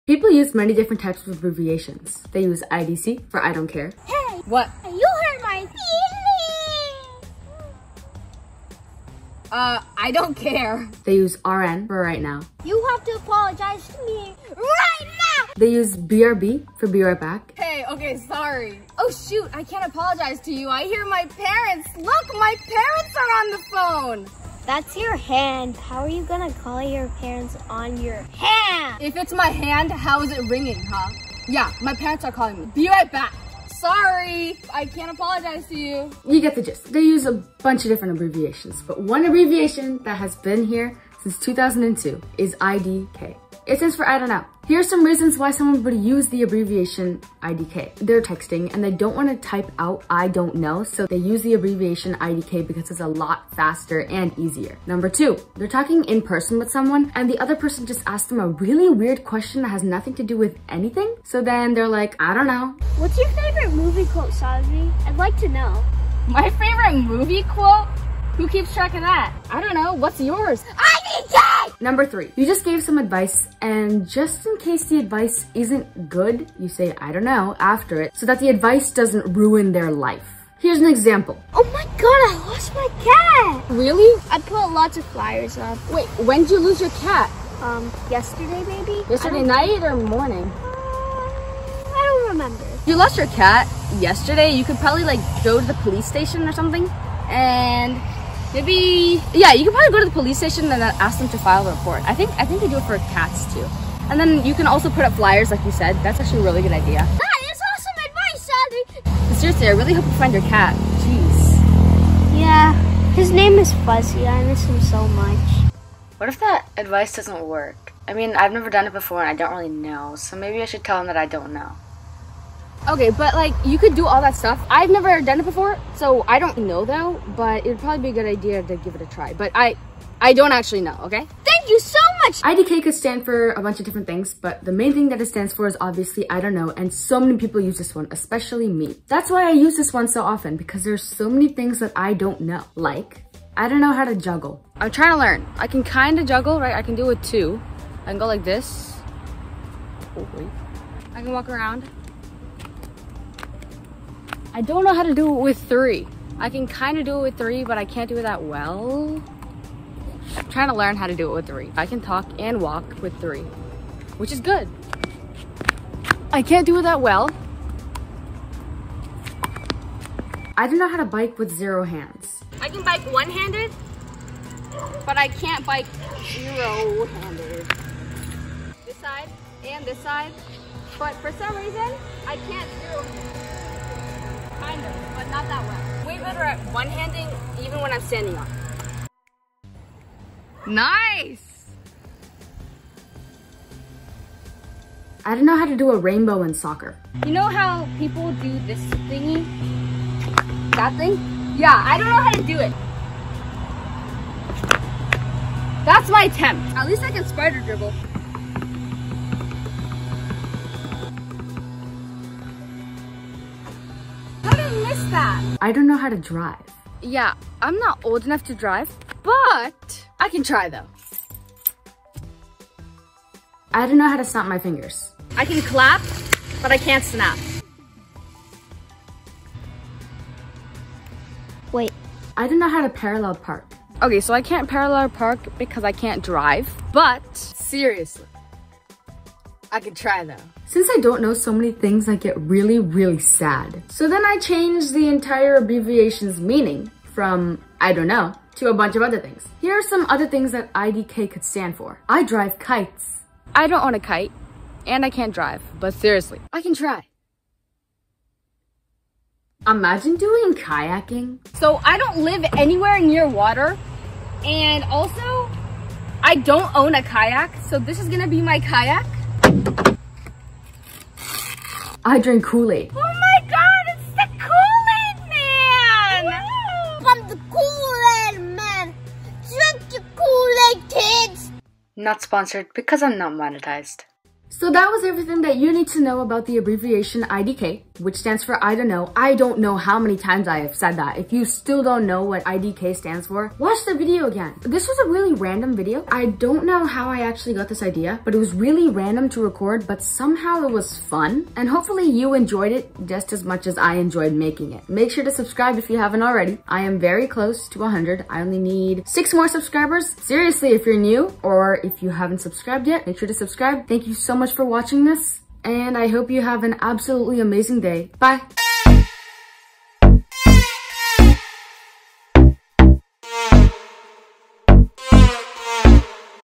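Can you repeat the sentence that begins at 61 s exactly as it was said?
So then they're like, I don't know.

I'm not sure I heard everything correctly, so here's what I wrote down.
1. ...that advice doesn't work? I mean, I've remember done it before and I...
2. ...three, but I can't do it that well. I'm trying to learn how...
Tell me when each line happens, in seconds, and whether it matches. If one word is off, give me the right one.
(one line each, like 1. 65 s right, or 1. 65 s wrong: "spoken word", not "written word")
1. 116 s wrong: "never", not "remember"
2. 157 s right.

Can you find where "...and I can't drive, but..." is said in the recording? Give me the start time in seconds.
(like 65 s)
254 s.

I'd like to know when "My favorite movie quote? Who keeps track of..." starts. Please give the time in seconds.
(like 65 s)
66 s.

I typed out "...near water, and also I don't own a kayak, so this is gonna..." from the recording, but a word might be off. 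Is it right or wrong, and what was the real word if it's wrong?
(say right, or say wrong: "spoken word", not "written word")
right.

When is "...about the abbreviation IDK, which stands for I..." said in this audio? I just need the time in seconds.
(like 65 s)
286 s.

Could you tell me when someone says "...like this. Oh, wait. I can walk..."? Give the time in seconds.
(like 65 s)
148 s.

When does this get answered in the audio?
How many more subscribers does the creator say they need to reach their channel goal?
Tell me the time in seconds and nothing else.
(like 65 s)
309 s.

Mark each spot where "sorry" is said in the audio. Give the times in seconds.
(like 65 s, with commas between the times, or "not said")
18 s, 33 s.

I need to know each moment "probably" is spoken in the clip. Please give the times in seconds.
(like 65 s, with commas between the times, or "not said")
94 s, 99 s, 127 s.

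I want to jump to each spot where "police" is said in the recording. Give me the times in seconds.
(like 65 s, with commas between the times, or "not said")
95 s, 100 s.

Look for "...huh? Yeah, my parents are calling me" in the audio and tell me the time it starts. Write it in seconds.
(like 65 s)
30 s.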